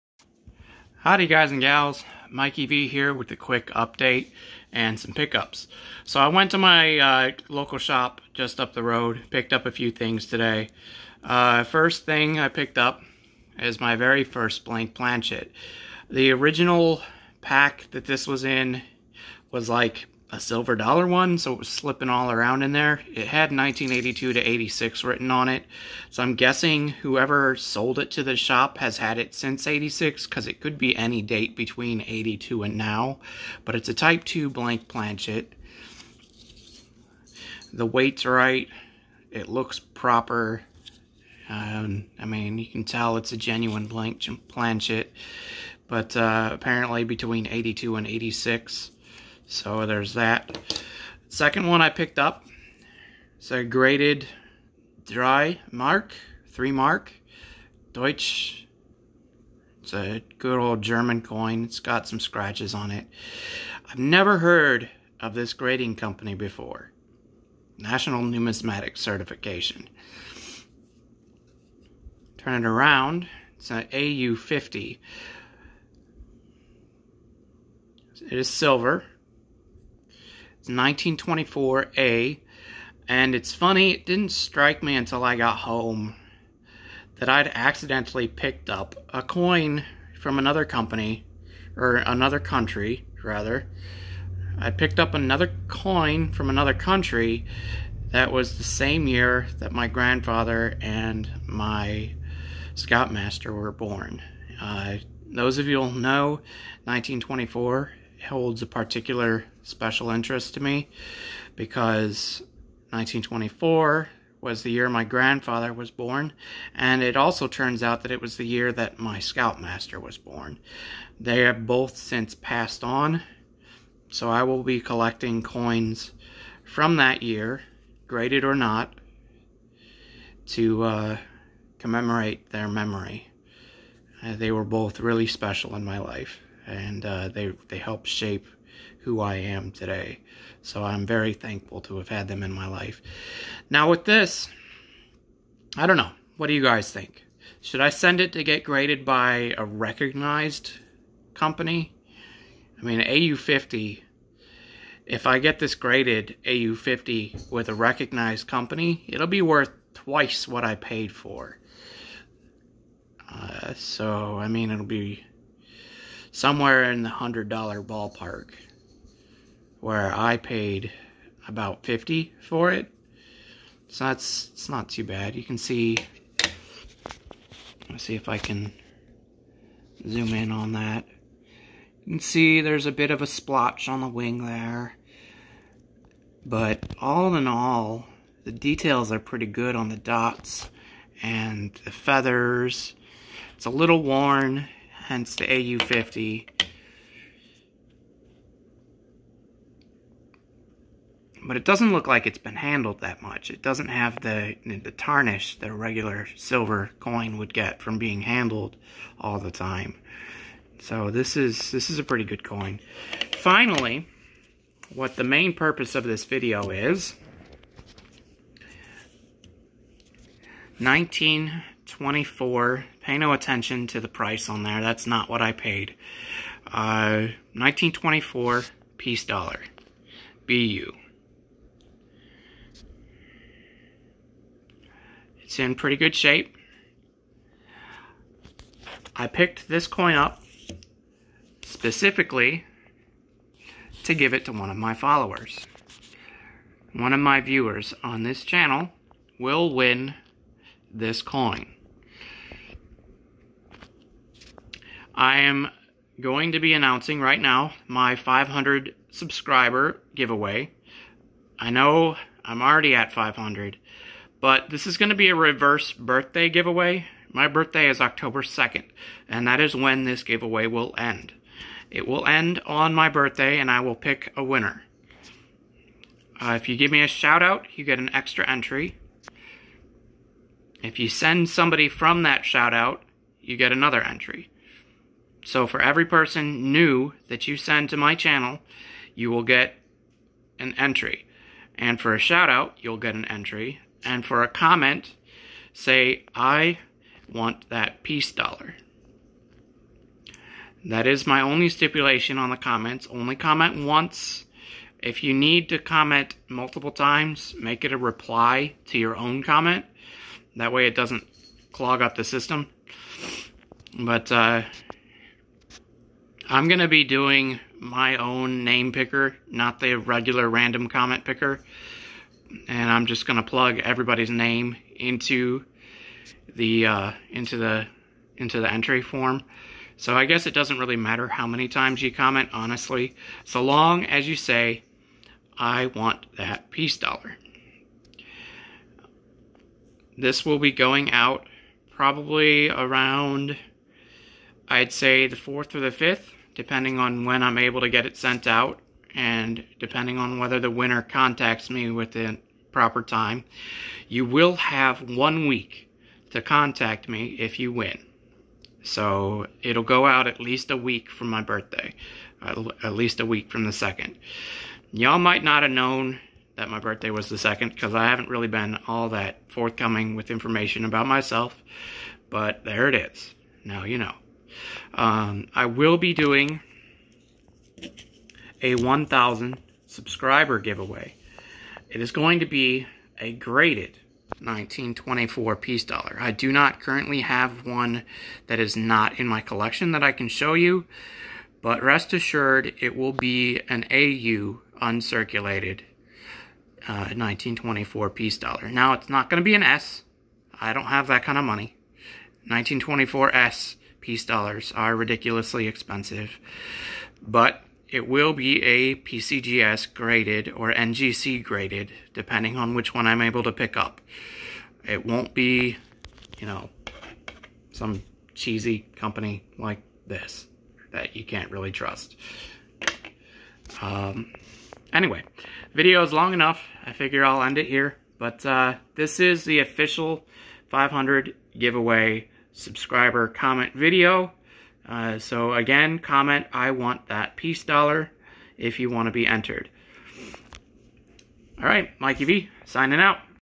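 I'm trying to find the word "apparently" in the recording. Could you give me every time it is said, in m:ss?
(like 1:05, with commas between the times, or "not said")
0:46.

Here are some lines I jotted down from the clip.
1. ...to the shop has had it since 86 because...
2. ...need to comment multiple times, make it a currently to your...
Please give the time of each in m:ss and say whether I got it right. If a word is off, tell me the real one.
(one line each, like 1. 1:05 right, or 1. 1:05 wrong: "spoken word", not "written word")
1. 0:28 right
2. 5:05 wrong: "reply", not "currently".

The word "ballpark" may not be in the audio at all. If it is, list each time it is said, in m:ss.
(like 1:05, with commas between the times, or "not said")
2:47.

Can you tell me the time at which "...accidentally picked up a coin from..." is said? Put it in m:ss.
1:27.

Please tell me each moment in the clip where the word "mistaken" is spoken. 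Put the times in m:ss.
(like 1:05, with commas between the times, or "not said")
not said.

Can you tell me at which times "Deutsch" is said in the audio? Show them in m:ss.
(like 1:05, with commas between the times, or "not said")
0:57.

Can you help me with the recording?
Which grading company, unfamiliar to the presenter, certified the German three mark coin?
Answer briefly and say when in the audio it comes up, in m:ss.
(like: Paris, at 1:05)
National Numismatic Certification, at 1:07.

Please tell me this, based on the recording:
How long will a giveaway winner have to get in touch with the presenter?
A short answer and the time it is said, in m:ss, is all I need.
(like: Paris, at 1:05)
One week, at 5:55.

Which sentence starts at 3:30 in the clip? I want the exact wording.
So this is, this is a pretty good coin.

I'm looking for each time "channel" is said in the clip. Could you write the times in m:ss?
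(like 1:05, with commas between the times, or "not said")
4:08, 4:48.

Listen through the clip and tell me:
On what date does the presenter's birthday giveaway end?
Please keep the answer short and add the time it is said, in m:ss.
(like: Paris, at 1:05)
October 2nd, at 4:27.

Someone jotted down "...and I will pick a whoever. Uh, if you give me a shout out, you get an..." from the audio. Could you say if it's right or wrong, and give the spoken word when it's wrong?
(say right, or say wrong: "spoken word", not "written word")
wrong: "winner", not "whoever".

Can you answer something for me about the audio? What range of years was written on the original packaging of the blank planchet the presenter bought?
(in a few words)
1982 to 86.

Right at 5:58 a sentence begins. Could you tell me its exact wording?
So it'll go out at least a week from my birthday, at least a week from the second.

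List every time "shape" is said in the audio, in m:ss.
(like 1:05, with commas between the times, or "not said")
2:18, 3:56.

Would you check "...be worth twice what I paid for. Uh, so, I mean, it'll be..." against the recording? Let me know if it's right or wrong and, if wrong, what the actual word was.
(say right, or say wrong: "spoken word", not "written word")
right.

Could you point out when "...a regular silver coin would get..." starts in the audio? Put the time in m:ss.
3:25.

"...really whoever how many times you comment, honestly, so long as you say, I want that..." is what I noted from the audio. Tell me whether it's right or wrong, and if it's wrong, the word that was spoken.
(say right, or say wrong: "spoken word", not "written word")
wrong: "matter", not "whoever".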